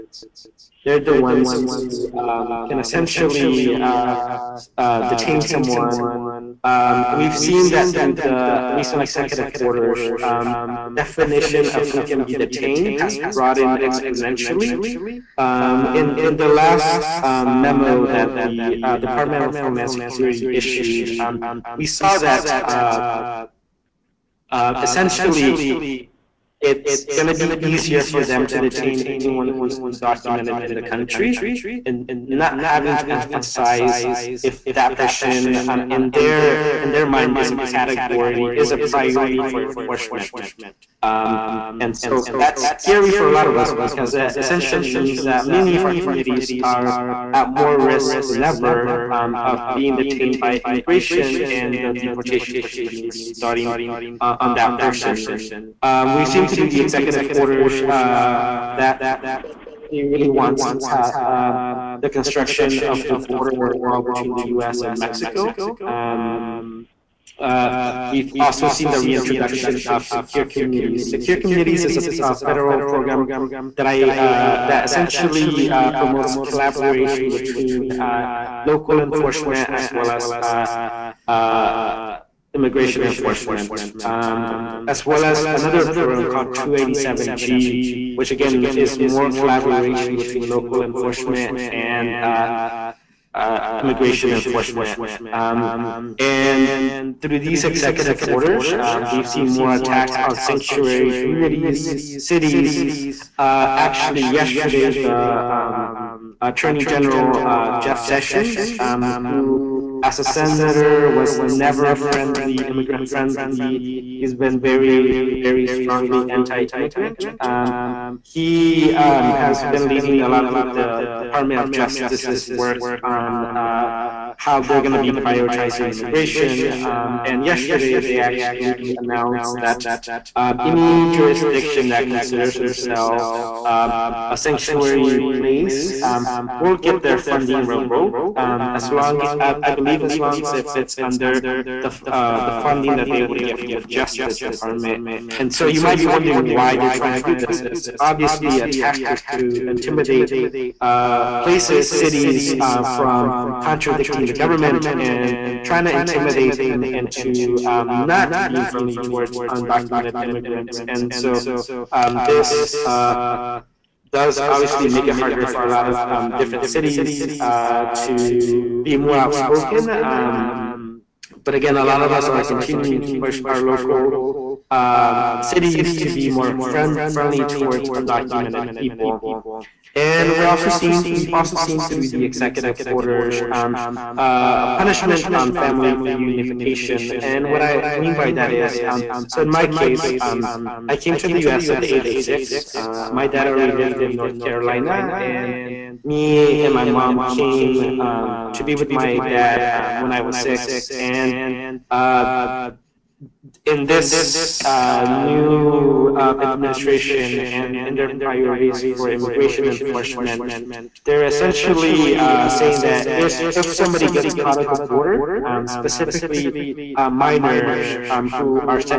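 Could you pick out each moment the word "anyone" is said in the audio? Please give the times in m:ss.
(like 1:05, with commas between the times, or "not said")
0:29.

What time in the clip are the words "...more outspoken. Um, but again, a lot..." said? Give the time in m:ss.
2:48.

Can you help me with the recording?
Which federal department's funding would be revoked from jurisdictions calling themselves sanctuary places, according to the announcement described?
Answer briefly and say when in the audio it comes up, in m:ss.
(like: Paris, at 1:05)
Justice Department, at 2:23.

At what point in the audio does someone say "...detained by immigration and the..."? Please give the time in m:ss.
0:49.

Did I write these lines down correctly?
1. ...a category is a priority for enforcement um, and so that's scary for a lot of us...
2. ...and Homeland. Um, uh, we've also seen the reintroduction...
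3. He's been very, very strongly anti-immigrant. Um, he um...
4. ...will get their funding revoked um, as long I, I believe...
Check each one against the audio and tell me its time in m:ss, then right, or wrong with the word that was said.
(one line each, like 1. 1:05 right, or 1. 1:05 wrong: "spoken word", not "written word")
1. 0:37 right
2. 1:04 wrong: "Mexico", not "Homeland"
3. 1:54 right
4. 2:16 right.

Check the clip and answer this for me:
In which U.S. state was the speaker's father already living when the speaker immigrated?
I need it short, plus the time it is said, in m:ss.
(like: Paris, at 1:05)
North Carolina, at 3:14.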